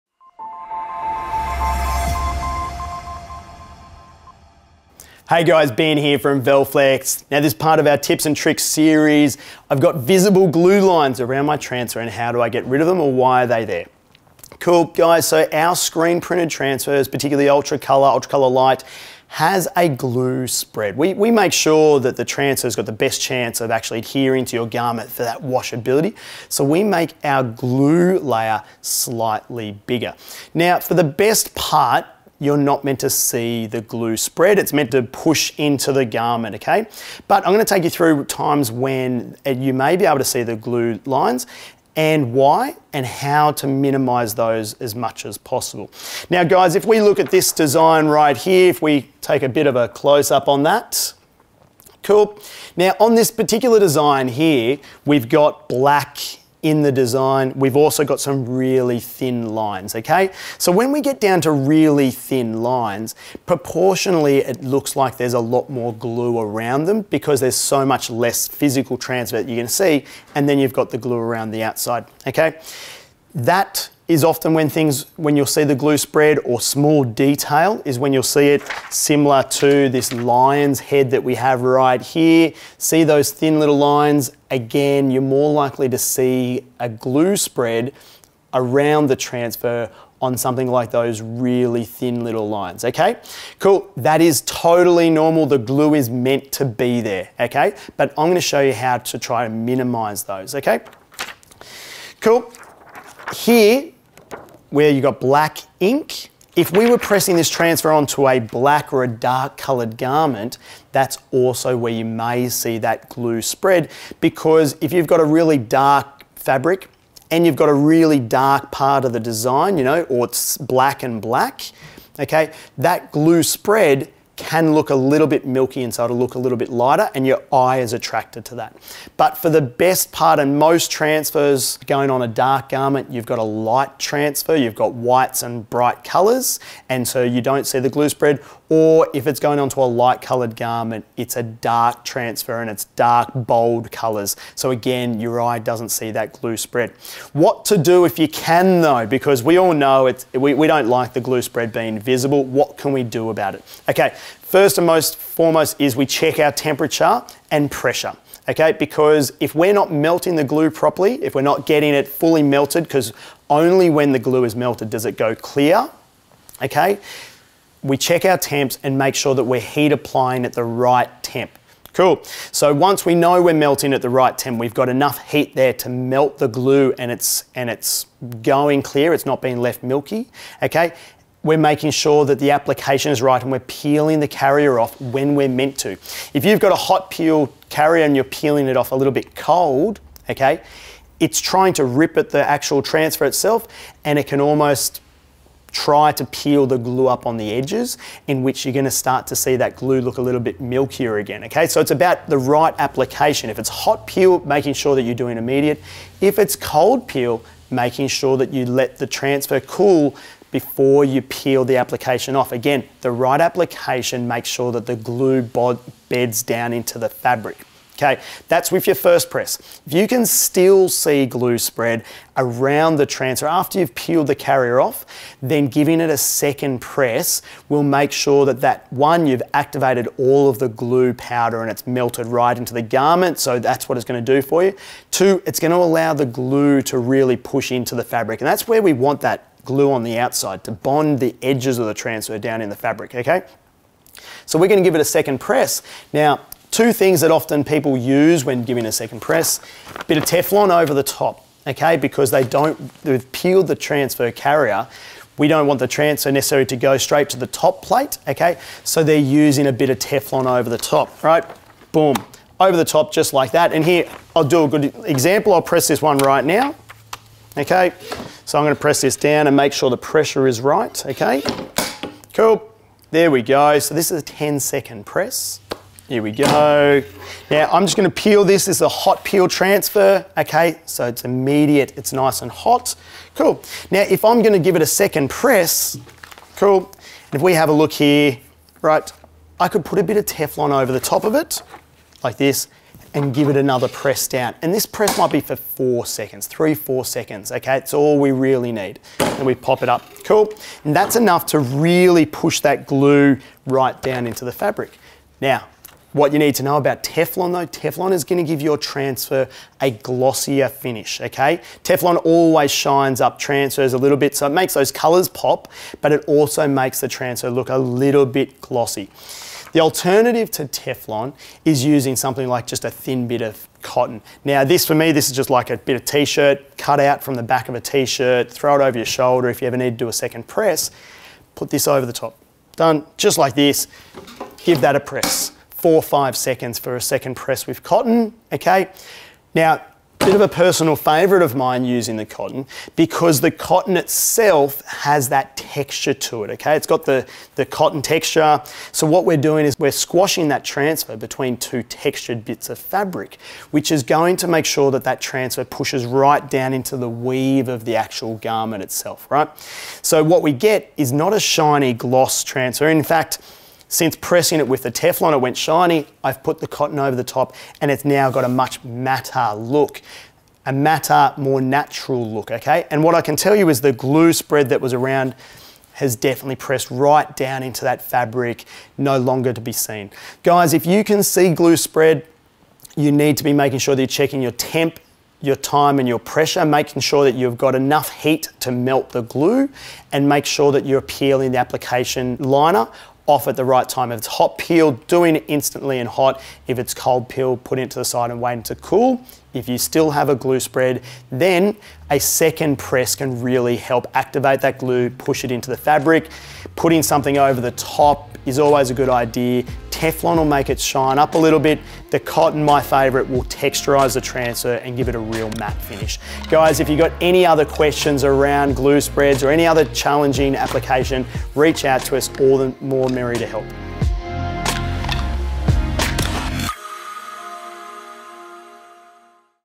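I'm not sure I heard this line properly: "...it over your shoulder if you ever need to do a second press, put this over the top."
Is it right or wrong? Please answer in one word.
right.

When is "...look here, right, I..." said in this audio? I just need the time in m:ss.
4:47.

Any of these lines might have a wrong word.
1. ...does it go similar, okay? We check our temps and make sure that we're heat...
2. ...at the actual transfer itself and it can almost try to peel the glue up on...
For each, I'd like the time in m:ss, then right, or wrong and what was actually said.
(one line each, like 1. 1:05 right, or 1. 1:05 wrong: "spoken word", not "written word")
1. 2:44 wrong: "clear", not "similar"
2. 3:12 right.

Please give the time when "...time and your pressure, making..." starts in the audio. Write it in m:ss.
6:25.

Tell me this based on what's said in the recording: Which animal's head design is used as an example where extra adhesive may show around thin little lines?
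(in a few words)
Lion.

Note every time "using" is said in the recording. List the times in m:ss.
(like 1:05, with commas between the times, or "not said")
4:19, 5:21, 5:41.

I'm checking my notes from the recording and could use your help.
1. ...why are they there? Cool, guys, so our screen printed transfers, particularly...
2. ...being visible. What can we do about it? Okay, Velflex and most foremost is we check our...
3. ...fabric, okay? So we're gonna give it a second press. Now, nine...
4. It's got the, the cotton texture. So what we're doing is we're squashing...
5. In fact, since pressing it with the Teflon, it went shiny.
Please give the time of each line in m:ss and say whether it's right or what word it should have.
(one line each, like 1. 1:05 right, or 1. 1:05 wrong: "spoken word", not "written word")
1. 0:13 right
2. 2:31 wrong: "First", not "Velflex"
3. 4:02 wrong: "two", not "nine"
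4. 5:46 right
5. 6:02 right.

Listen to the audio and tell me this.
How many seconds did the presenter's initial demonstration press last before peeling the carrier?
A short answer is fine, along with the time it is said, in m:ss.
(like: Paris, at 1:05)
10 seconds, at 4:34.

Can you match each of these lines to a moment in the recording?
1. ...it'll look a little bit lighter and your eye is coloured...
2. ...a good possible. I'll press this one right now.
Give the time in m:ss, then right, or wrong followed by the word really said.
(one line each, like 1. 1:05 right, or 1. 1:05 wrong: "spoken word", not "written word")
1. 2:06 wrong: "attracted", not "coloured"
2. 4:24 wrong: "example", not "possible".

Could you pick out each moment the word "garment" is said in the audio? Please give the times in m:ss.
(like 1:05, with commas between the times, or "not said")
0:24, 0:36, 1:49, 2:12, 2:20, 3:52, 5:58.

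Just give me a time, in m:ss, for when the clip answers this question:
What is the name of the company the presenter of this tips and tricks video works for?
0:06.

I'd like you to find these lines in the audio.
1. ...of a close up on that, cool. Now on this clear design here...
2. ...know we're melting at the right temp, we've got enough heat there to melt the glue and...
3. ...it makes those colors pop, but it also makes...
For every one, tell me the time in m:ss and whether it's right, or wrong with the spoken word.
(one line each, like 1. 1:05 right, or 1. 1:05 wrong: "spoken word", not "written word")
1. 0:49 wrong: "particular", not "clear"
2. 2:53 right
3. 5:14 right.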